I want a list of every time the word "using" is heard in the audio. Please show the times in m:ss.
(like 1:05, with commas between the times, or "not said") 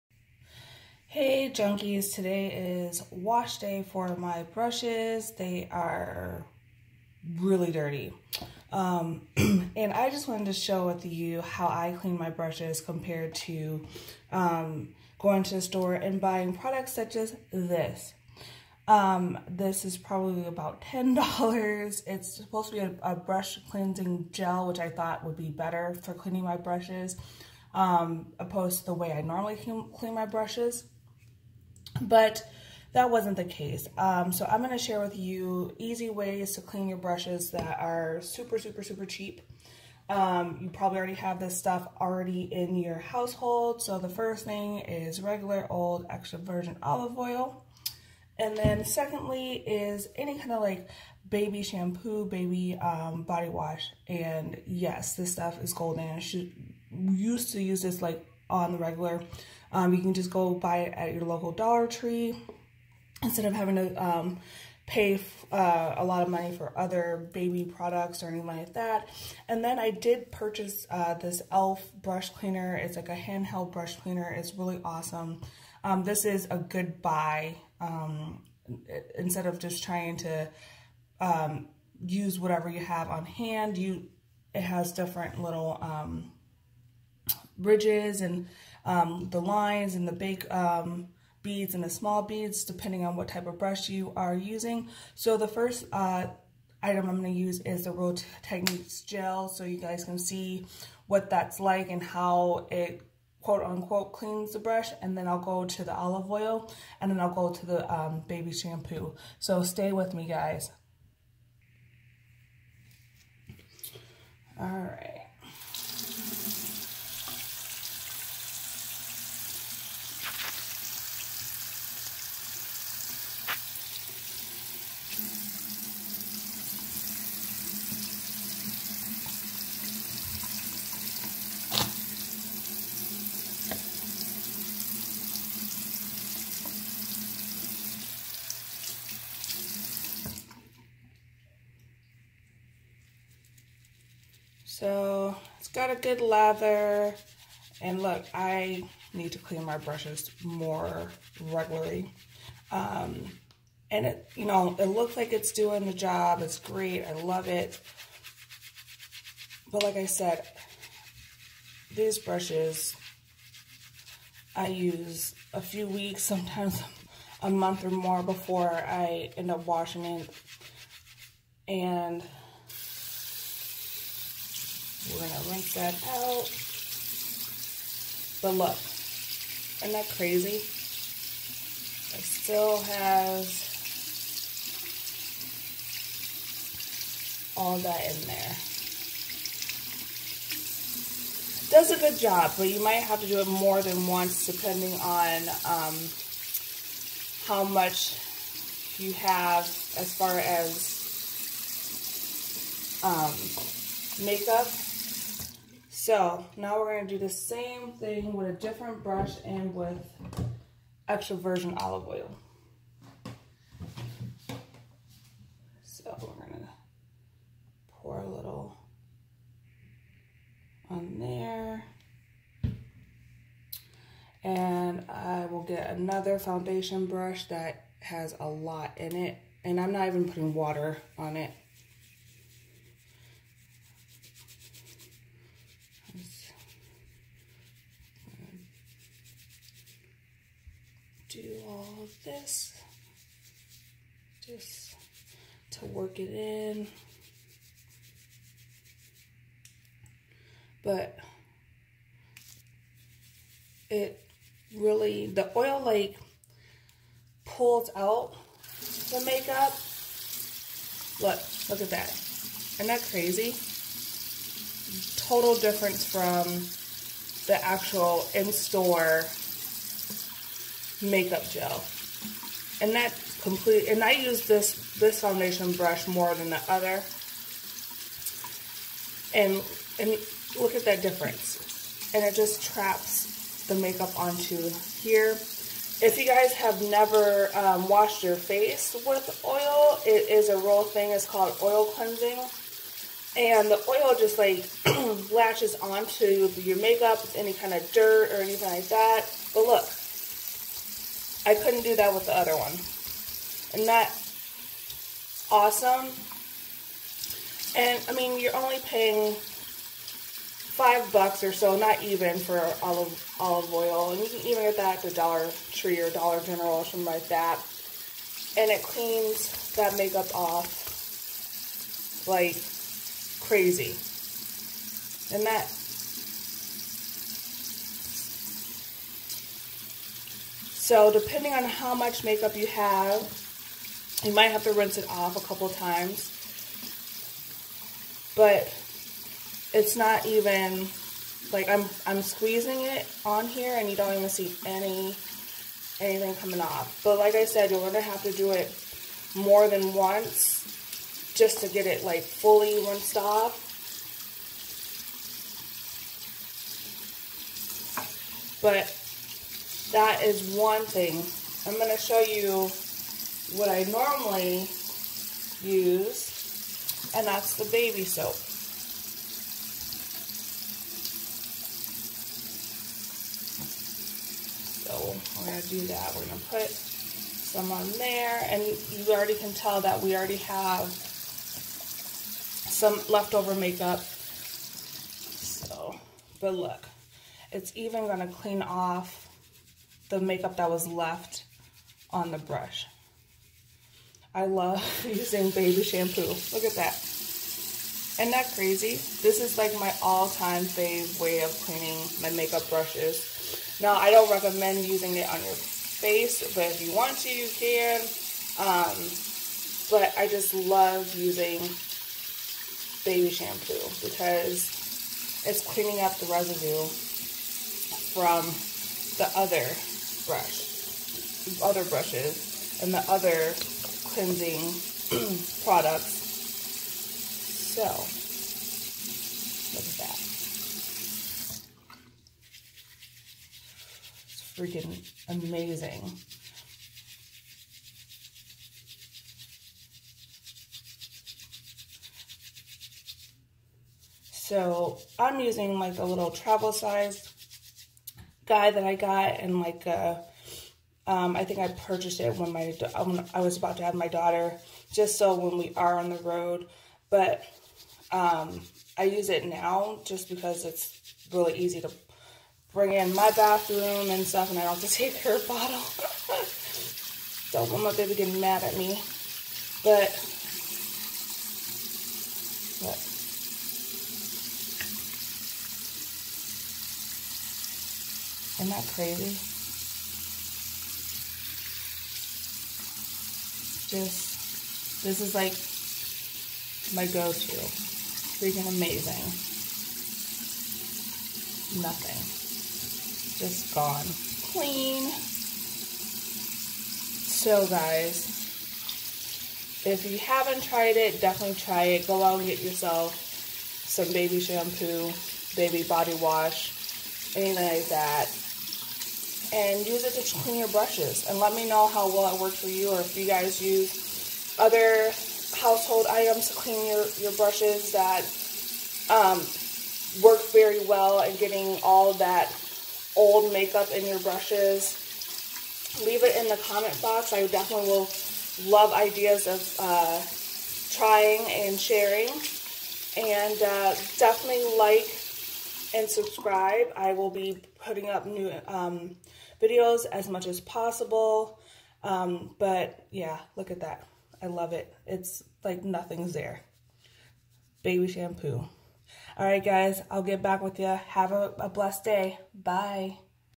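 1:34, 6:35, 6:44, 6:51, 7:25.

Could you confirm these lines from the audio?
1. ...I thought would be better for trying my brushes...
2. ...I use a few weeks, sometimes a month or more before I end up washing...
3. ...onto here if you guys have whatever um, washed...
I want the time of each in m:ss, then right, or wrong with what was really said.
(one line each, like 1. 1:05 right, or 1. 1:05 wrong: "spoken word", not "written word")
1. 0:24 wrong: "cleaning", not "trying"
2. 2:44 right
3. 4:44 wrong: "never", not "whatever".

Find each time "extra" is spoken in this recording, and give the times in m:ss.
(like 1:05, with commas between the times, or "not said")
0:46, 3:31.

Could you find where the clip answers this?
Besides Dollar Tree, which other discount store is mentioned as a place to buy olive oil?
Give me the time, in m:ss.
5:16.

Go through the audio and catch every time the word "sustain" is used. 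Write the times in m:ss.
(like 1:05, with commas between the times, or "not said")
not said.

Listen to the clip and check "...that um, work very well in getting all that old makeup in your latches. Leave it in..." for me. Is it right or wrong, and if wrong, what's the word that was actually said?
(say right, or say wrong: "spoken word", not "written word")
wrong: "brushes", not "latches".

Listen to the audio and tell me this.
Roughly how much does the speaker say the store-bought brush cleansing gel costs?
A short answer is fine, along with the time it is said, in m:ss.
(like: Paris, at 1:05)
$10, at 0:20.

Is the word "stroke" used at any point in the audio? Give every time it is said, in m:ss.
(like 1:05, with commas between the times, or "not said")
not said.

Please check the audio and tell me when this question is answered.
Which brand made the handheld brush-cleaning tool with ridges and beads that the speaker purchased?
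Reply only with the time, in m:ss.
1:11.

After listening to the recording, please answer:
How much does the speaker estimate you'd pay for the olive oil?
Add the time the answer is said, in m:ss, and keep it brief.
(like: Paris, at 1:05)
5 bucks, at 5:09.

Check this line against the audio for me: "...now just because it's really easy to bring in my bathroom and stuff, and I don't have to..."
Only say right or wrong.
right.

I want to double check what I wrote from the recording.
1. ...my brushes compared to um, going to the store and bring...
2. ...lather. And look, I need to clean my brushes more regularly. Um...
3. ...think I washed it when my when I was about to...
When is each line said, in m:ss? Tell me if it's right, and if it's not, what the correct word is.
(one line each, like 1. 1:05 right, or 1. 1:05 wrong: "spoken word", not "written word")
1. 0:12 wrong: "buying", not "bring"
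2. 2:26 right
3. 7:31 wrong: "purchased", not "washed".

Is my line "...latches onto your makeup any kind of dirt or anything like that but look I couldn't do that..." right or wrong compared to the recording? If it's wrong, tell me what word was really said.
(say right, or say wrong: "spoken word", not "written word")
right.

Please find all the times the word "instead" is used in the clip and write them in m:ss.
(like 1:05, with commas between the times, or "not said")
1:03, 1:19.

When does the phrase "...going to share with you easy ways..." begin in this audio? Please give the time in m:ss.
0:34.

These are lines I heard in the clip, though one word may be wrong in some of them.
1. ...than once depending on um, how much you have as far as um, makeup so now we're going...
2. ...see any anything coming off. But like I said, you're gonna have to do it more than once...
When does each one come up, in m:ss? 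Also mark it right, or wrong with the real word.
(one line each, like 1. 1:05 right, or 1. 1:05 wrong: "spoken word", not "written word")
1. 3:13 right
2. 5:44 right.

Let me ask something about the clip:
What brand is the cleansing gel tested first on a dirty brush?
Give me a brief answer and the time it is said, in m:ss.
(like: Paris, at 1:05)
Real Techniques, at 1:37.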